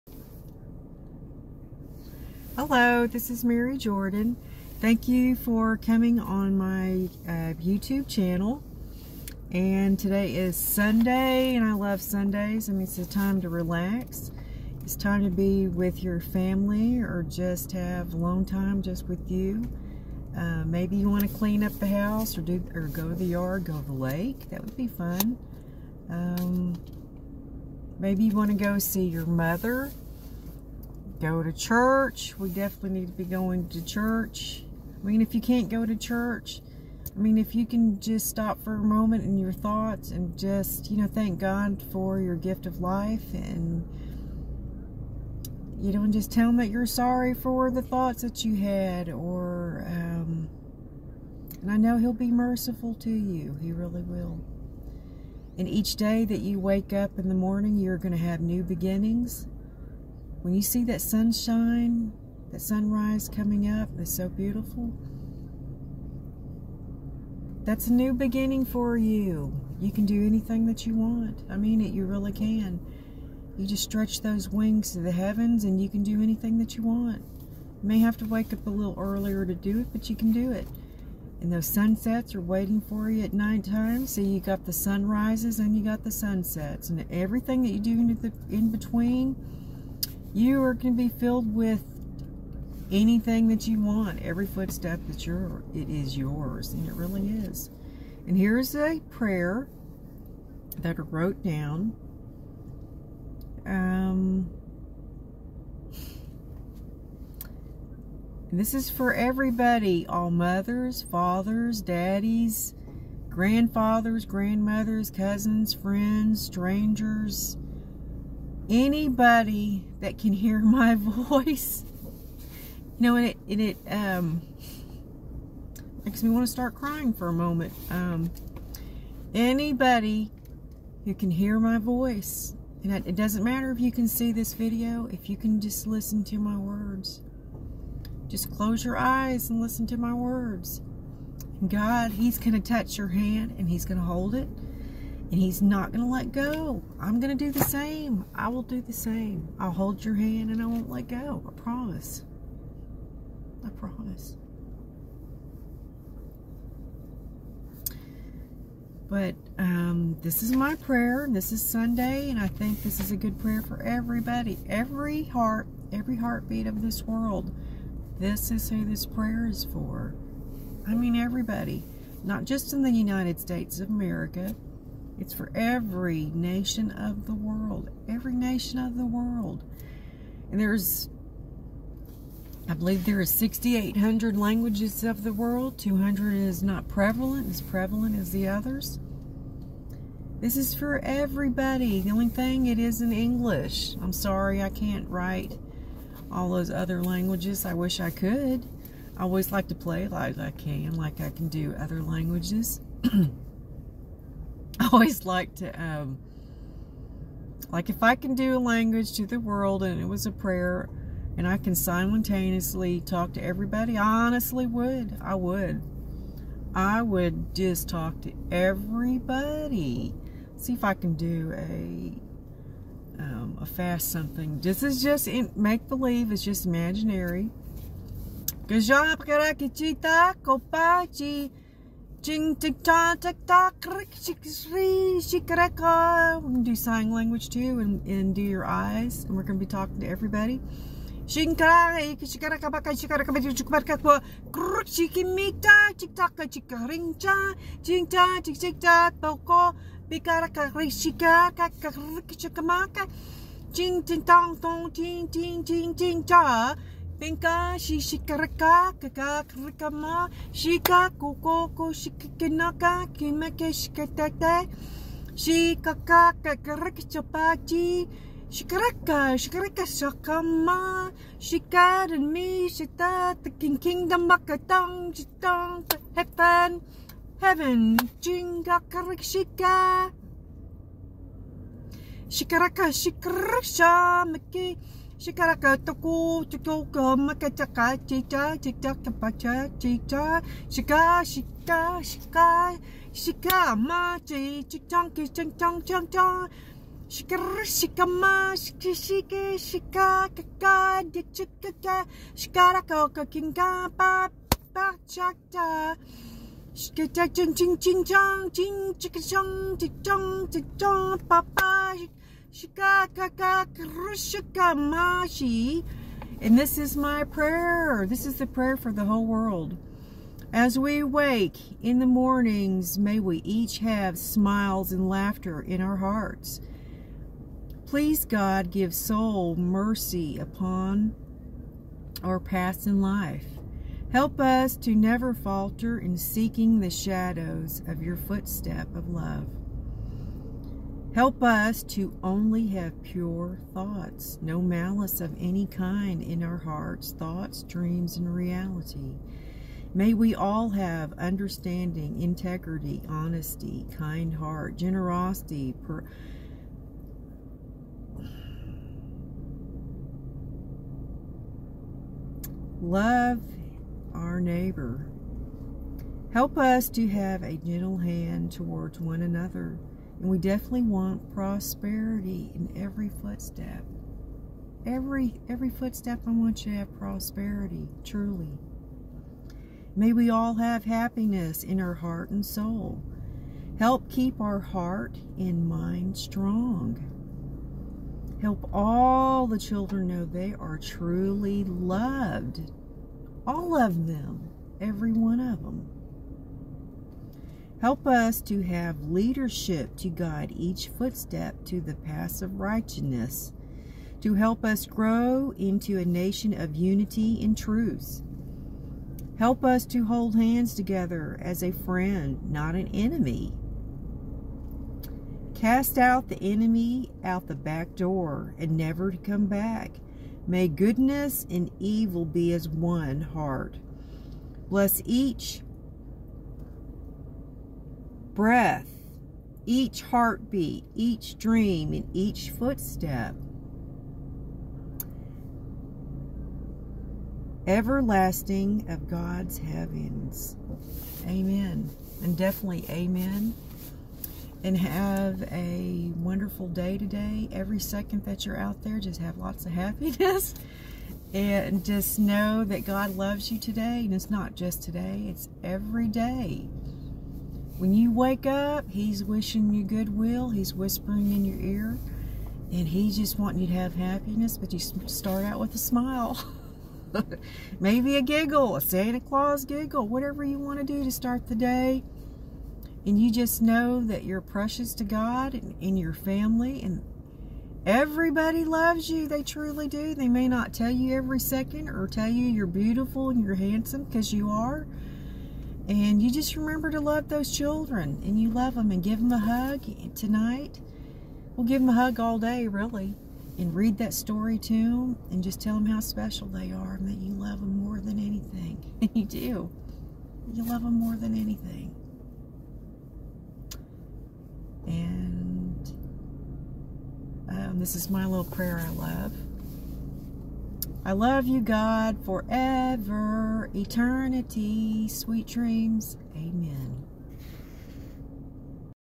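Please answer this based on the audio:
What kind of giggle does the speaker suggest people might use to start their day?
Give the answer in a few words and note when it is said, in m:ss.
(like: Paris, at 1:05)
Santa Claus giggle, at 7:48.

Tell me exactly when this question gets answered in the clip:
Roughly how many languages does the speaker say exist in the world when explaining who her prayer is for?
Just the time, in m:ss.
3:03.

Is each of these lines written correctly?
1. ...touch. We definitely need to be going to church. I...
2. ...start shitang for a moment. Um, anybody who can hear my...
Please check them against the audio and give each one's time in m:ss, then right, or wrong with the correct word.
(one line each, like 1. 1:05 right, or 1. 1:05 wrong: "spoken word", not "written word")
1. 0:31 wrong: "church", not "touch"
2. 2:06 wrong: "crying", not "shitang".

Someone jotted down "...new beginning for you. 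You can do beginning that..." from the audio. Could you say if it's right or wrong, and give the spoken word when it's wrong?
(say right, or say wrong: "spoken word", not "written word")
wrong: "anything", not "beginning".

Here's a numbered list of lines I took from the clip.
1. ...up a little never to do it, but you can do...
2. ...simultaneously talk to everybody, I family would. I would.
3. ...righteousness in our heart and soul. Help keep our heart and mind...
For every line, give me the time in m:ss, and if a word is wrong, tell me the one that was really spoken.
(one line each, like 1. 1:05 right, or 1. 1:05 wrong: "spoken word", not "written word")
1. 1:18 wrong: "earlier", not "never"
2. 3:31 wrong: "honestly", not "family"
3. 6:20 wrong: "happiness", not "righteousness".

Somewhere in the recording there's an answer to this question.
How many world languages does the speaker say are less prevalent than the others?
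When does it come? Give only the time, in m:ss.
3:05.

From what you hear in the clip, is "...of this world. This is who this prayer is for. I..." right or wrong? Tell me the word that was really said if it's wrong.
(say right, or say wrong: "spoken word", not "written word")
right.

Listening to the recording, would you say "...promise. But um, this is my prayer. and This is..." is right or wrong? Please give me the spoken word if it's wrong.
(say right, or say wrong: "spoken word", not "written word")
right.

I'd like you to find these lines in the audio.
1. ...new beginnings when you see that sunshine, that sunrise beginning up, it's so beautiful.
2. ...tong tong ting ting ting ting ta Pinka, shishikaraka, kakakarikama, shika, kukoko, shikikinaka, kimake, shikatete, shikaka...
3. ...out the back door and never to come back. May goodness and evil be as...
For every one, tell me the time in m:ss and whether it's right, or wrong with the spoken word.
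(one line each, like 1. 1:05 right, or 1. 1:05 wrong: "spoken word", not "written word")
1. 0:58 wrong: "coming", not "beginning"
2. 4:14 right
3. 6:57 right.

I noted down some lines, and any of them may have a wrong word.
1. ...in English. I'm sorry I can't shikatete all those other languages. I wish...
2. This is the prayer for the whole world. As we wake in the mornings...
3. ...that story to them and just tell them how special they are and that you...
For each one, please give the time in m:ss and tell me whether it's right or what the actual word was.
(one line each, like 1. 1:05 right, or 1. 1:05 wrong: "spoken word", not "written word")
1. 3:13 wrong: "write", not "shikatete"
2. 5:18 right
3. 8:13 right.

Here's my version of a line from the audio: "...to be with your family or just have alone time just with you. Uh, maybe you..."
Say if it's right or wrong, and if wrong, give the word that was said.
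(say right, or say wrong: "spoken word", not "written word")
right.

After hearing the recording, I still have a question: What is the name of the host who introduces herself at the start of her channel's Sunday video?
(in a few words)
Mary Jordan.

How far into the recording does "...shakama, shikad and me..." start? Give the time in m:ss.
4:29.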